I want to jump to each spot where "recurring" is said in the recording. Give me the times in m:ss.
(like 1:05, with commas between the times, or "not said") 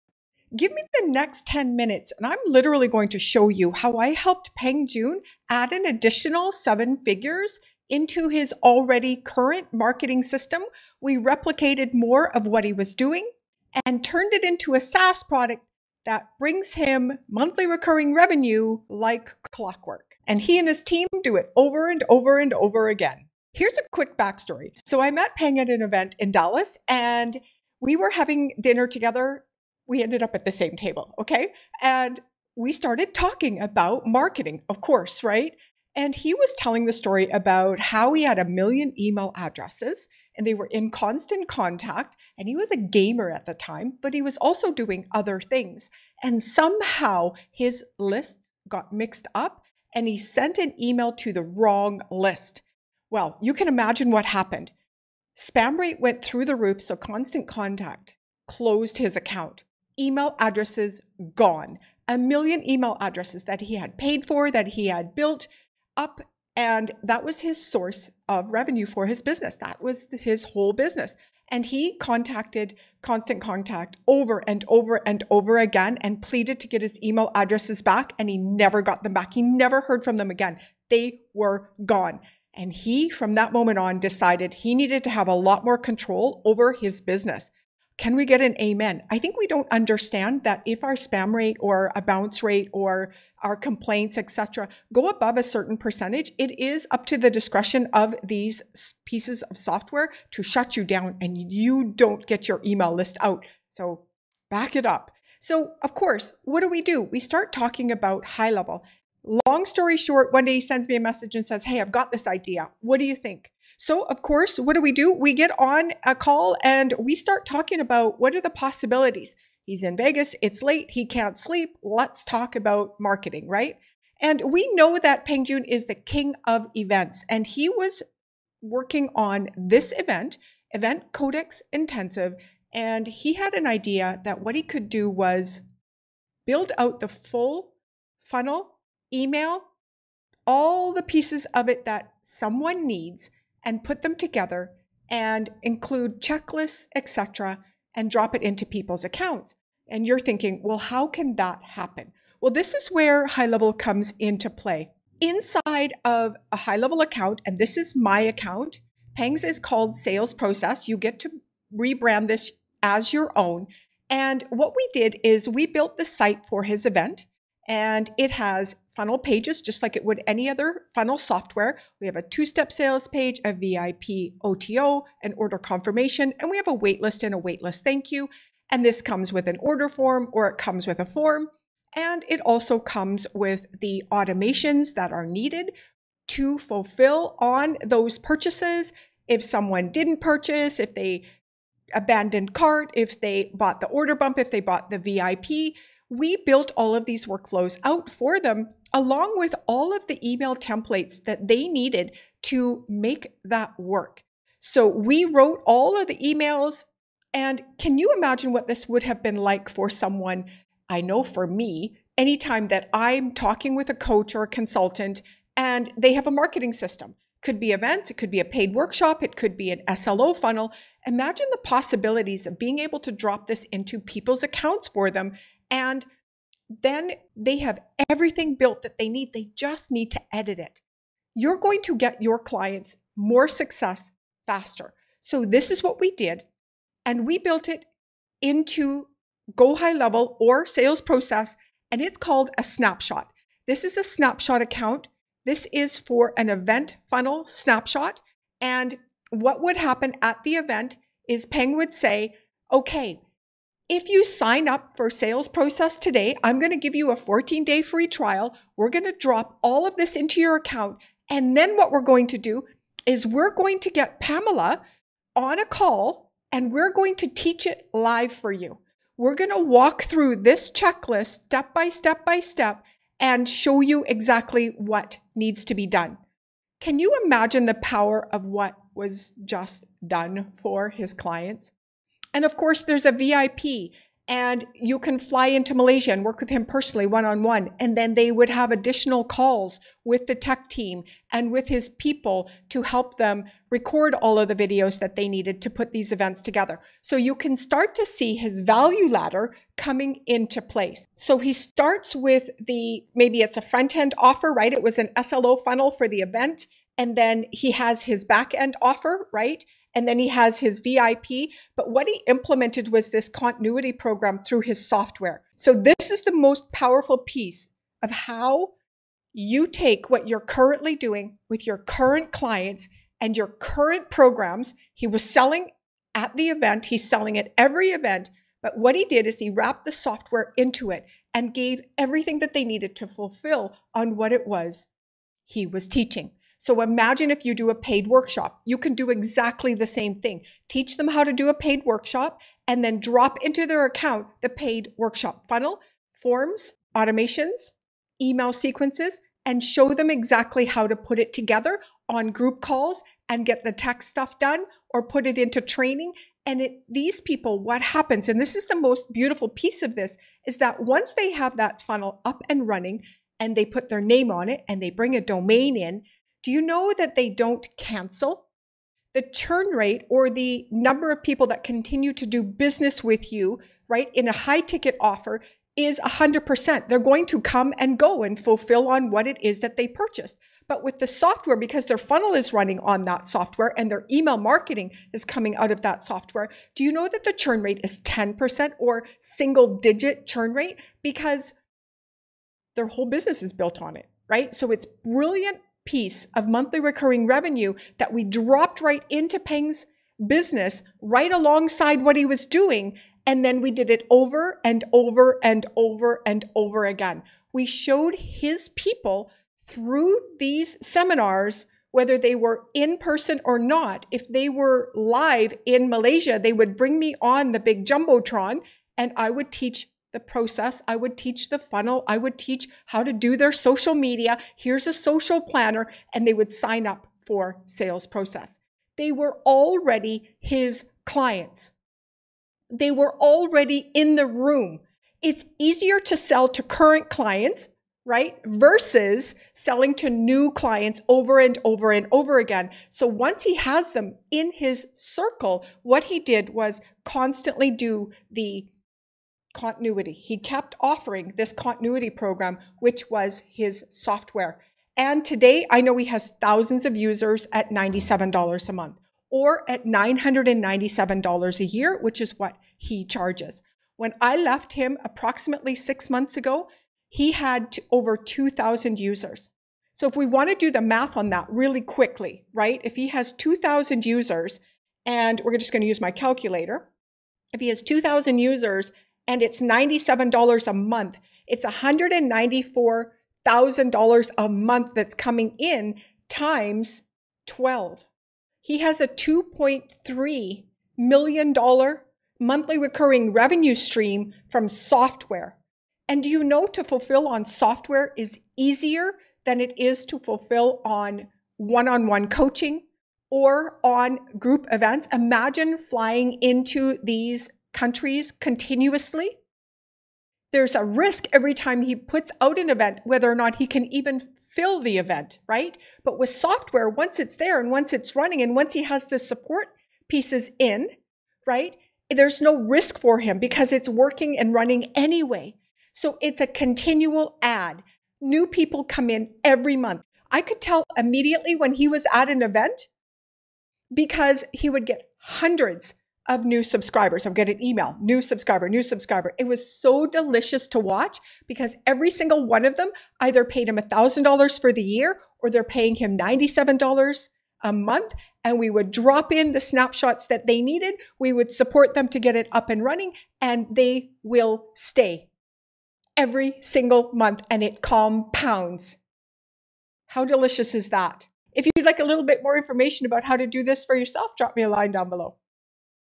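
0:17, 6:36, 8:12.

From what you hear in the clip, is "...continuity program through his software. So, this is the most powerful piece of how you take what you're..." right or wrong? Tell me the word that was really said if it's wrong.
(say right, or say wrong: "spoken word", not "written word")
right.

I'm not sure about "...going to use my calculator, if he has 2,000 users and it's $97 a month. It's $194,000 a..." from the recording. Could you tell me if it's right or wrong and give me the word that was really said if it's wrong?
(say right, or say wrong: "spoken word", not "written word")
right.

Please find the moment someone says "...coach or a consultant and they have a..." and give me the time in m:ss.
3:33.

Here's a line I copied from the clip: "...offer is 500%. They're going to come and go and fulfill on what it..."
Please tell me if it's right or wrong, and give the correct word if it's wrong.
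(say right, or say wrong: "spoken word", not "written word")
wrong: "100", not "500".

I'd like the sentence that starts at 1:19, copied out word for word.
He never heard from them again.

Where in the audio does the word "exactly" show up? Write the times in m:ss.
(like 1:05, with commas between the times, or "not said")
4:34, 5:39, 5:50.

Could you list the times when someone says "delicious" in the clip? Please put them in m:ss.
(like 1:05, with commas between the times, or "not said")
9:00, 9:20.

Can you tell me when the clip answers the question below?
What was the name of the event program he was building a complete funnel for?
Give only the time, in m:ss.
2:10.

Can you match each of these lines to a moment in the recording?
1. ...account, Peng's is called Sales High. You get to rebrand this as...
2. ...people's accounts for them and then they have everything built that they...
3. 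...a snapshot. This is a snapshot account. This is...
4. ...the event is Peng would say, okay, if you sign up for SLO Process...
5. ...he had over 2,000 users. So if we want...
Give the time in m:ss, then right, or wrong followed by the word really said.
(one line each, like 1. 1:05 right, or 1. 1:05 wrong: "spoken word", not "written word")
1. 2:38 wrong: "Process", not "High"
2. 3:43 right
3. 4:02 right
4. 4:10 wrong: "Sales", not "SLO"
5. 7:47 right.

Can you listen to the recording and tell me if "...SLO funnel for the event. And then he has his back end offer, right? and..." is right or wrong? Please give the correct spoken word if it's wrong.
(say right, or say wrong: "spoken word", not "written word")
right.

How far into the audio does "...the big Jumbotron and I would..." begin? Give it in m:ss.
6:57.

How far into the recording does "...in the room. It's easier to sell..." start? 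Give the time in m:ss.
7:13.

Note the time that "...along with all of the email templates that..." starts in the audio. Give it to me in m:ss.
3:18.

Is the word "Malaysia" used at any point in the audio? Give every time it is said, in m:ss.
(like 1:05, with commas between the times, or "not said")
4:45, 6:55.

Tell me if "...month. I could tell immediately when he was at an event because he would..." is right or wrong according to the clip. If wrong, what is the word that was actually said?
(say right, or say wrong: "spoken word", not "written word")
right.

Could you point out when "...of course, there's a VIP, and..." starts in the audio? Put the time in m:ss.
4:42.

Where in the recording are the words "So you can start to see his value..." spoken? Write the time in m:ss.
4:57.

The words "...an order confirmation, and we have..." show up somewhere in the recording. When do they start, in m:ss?
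2:55.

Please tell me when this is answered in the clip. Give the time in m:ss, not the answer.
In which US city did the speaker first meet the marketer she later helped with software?
0:26.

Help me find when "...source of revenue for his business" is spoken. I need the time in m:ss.
1:07.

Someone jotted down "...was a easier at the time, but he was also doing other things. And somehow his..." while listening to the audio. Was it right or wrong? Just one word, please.
wrong.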